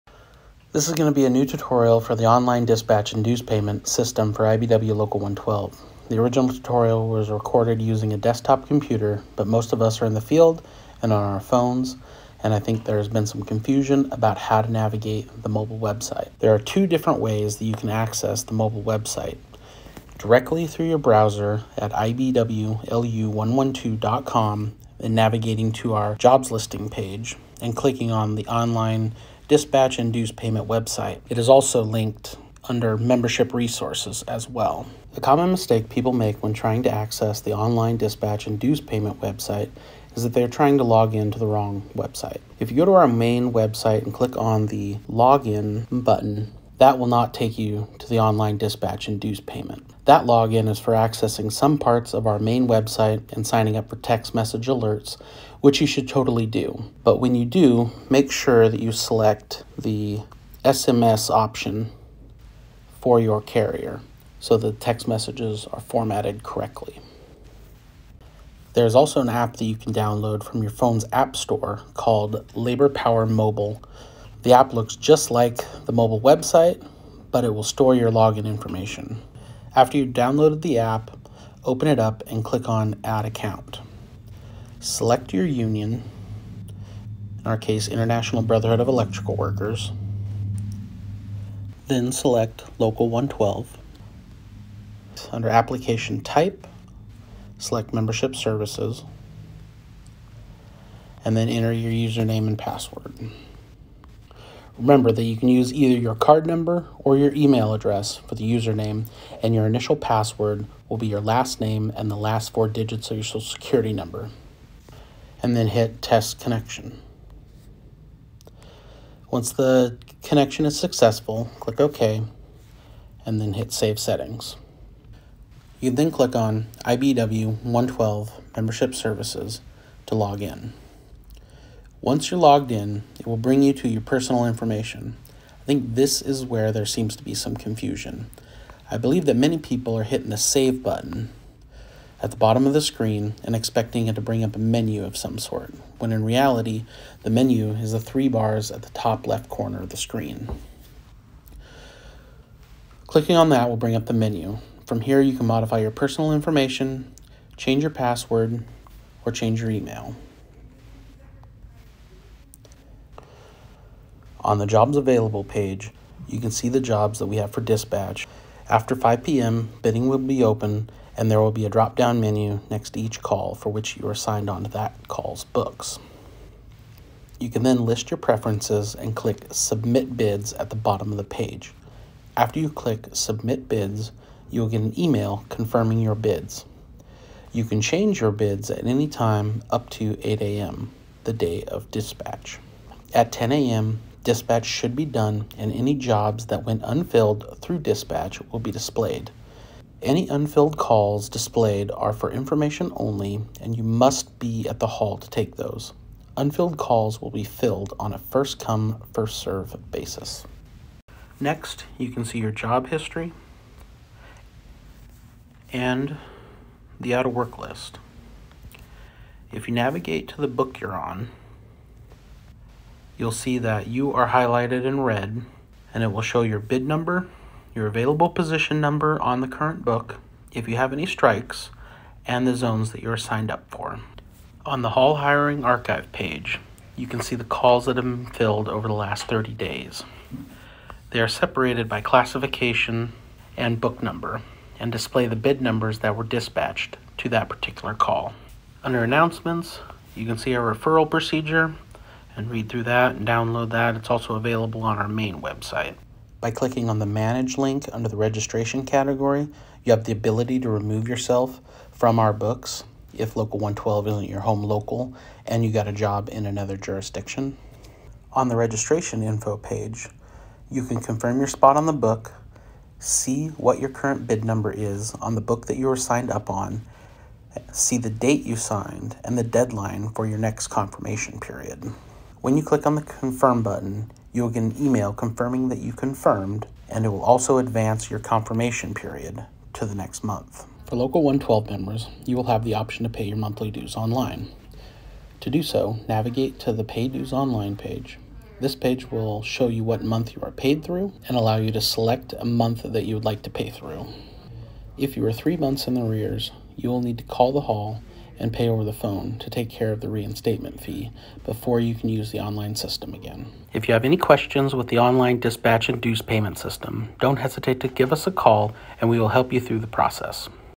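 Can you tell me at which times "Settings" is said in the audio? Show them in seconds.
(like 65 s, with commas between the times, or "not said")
123 s.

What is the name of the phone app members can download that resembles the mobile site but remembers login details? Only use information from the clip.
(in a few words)
Labor Power Mobile.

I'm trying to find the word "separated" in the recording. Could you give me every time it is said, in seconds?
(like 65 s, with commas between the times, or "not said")
241 s.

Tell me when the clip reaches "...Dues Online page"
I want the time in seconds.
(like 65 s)
297 s.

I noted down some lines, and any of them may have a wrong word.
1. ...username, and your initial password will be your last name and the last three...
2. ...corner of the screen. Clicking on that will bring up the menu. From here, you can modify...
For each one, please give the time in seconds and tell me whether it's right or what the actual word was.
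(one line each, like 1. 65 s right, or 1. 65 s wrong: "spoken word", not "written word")
1. 108 s wrong: "four", not "three"
2. 149 s right.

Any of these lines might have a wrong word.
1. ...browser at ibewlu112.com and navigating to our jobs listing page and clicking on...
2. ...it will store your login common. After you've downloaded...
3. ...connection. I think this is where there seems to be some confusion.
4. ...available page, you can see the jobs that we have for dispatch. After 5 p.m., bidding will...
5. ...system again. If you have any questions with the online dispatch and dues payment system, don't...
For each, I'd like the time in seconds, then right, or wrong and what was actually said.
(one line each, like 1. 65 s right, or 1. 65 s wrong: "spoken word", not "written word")
1. 20 s right
2. 77 s wrong: "information", not "common"
3. 134 s wrong: "information", not "connection"
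4. 164 s right
5. 312 s right.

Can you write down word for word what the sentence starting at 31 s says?
It is also linked under membership resources as well.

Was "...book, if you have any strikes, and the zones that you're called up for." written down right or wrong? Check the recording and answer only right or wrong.
wrong.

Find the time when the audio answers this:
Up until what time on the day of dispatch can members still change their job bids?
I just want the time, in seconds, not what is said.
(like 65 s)
190 s.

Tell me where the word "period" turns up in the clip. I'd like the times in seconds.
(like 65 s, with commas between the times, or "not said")
281 s, 288 s.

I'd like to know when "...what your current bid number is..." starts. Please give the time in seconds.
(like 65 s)
273 s.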